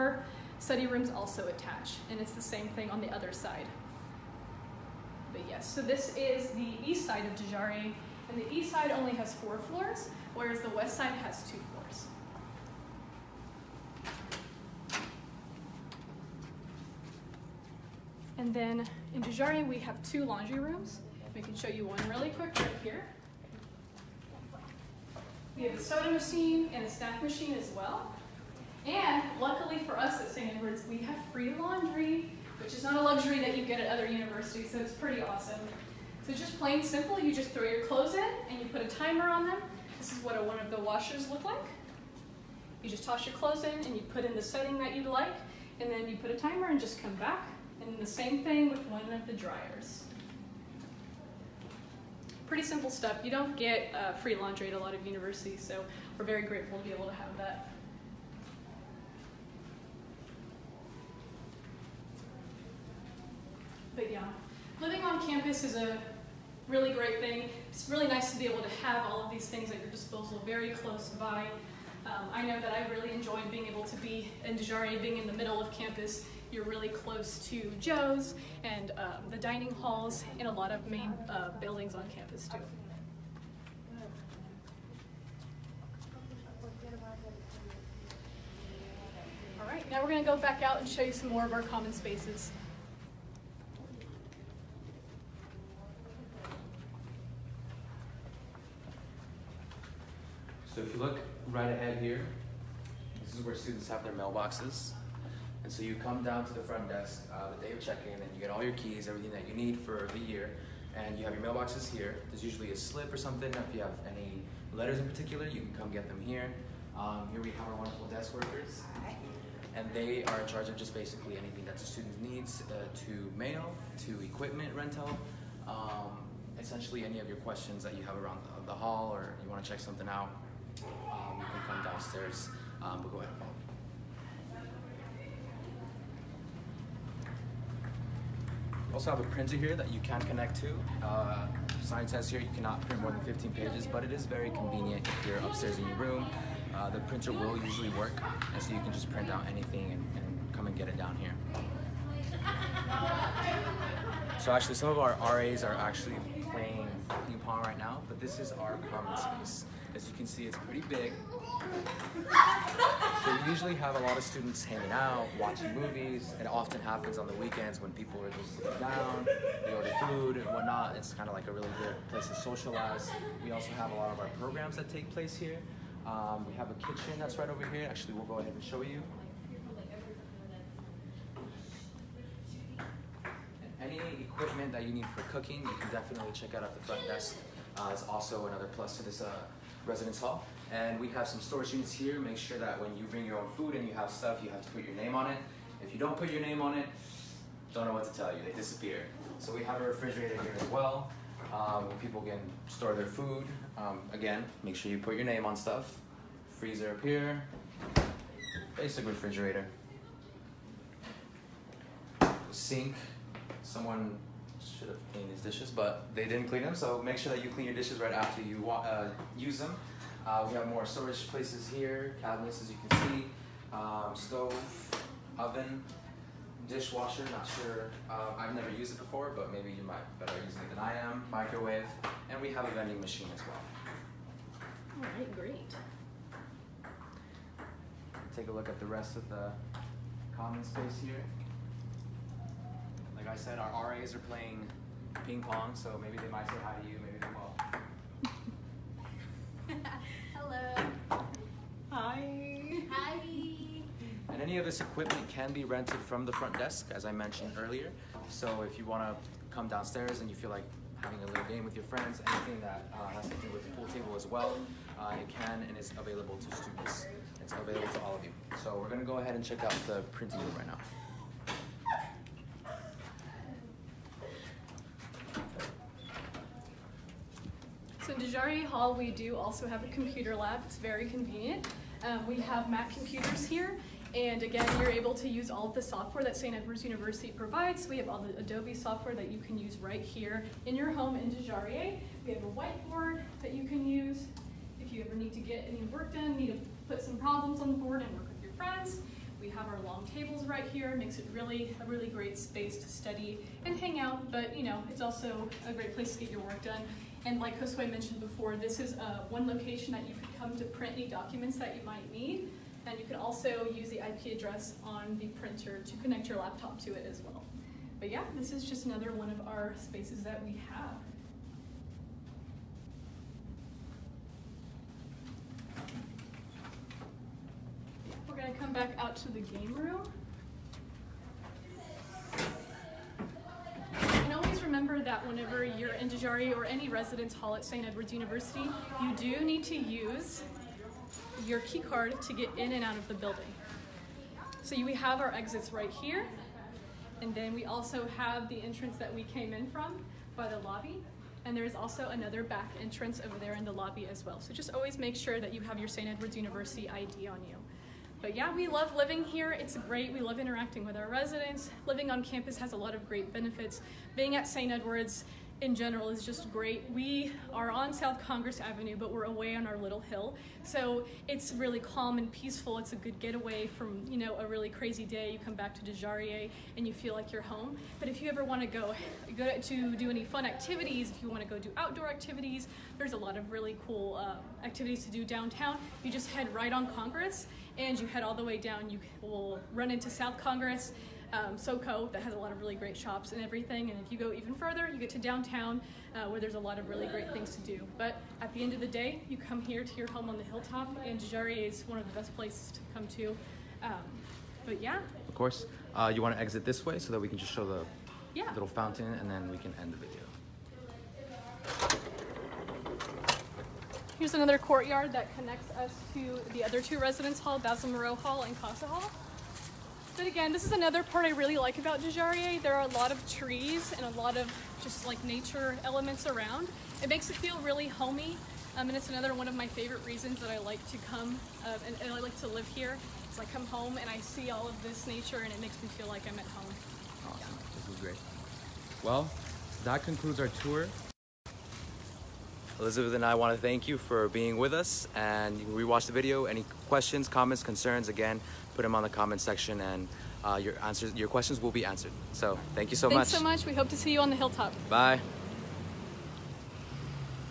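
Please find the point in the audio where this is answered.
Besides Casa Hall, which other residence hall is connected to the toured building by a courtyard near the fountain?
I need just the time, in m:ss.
6:57.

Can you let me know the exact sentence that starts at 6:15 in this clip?
You come back to Dujarié and you feel like you're home.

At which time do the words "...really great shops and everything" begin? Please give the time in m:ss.
6:32.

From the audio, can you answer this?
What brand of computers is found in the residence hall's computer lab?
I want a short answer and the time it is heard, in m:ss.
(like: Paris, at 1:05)
Mac, at 4:42.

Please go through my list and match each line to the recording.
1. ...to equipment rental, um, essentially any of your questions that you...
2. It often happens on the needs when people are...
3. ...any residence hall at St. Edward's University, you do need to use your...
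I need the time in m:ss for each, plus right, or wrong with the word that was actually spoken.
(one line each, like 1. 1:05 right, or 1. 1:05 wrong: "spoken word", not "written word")
1. 2:04 right
2. 2:46 wrong: "weekends", not "needs"
3. 5:36 right.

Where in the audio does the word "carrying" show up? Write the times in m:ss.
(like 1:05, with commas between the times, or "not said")
not said.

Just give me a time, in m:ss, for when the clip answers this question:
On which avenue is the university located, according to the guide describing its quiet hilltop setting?
6:07.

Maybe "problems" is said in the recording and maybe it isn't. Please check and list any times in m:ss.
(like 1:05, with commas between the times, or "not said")
4:57.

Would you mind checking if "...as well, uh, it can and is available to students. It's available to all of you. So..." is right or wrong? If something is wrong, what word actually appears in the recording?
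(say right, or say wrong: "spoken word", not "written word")
right.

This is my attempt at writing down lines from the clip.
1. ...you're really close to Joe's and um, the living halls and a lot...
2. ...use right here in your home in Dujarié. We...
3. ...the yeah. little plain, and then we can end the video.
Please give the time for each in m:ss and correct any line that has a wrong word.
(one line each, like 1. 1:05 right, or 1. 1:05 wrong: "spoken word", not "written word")
1. 1:16 wrong: "dining", not "living"
2. 4:49 right
3. 6:47 wrong: "fountain", not "plain".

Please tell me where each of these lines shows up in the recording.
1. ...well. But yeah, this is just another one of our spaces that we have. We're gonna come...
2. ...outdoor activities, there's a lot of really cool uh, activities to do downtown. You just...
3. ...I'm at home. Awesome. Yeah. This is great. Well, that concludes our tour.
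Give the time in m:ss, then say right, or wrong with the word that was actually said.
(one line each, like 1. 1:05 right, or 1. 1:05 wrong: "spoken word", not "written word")
1. 5:17 right
2. 6:21 right
3. 7:16 right.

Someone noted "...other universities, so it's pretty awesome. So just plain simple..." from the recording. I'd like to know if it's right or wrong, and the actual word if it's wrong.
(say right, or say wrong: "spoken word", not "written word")
right.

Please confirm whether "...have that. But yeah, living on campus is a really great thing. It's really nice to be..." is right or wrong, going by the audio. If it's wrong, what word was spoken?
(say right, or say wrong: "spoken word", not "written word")
right.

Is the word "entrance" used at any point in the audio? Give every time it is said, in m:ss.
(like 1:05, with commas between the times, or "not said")
5:48, 5:52.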